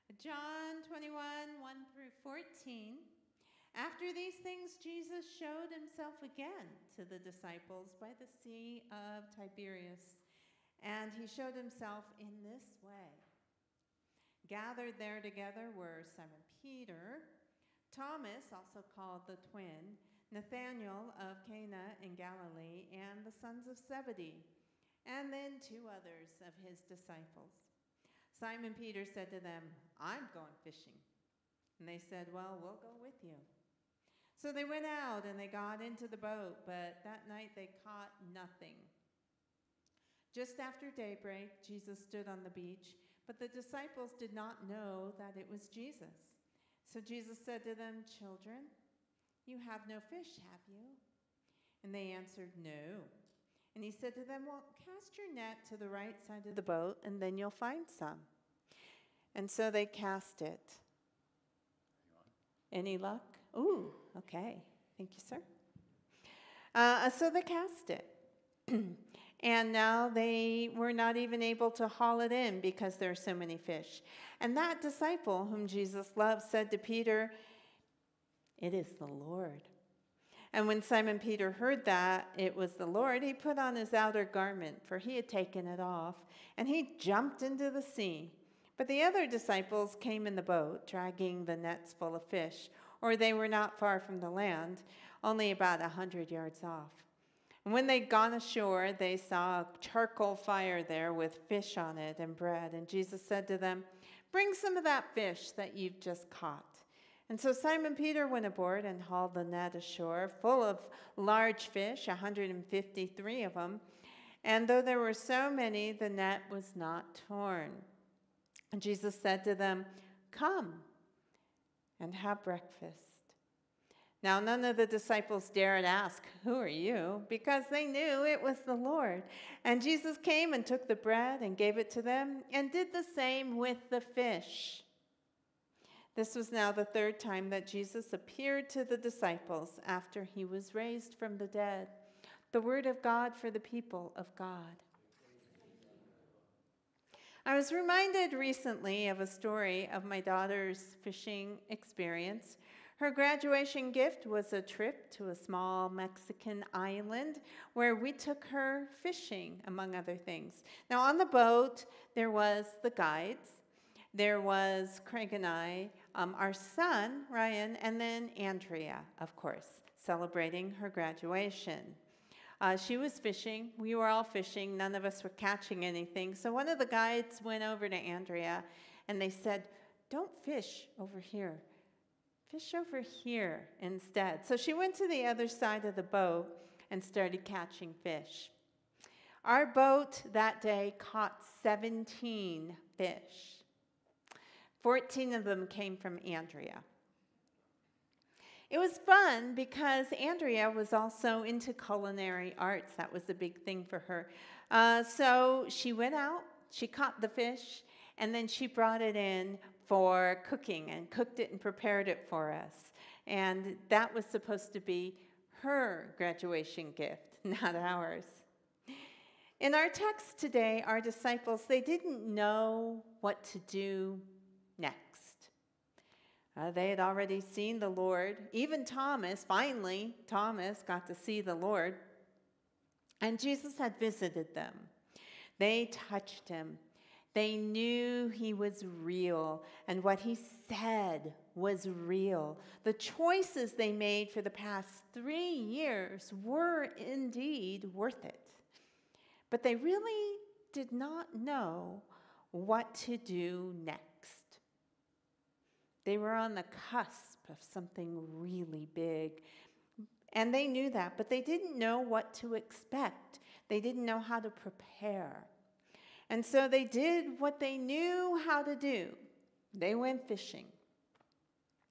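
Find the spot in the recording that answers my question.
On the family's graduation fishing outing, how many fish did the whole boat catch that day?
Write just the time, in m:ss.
3:11.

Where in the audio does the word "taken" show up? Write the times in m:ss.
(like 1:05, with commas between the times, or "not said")
1:25.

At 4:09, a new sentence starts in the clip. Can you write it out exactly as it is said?
But they really did not know what to do next.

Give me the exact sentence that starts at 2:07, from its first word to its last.
because they knew it was the Lord.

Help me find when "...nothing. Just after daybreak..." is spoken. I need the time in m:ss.
0:38.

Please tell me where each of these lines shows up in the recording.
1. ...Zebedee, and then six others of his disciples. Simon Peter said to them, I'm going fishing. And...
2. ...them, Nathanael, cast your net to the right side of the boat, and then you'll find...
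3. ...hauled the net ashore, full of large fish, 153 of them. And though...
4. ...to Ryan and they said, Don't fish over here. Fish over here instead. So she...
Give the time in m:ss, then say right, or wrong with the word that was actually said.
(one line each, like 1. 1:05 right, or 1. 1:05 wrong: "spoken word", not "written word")
1. 0:23 wrong: "two", not "six"
2. 0:54 wrong: "Well", not "Nathanael"
3. 1:49 right
4. 2:57 wrong: "Andrea", not "Ryan".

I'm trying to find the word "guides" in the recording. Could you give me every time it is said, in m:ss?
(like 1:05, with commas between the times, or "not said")
2:42, 2:56.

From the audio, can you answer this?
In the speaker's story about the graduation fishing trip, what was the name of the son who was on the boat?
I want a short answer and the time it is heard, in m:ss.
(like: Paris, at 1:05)
Ryan, at 2:47.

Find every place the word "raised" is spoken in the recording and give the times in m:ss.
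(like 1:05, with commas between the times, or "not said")
2:20.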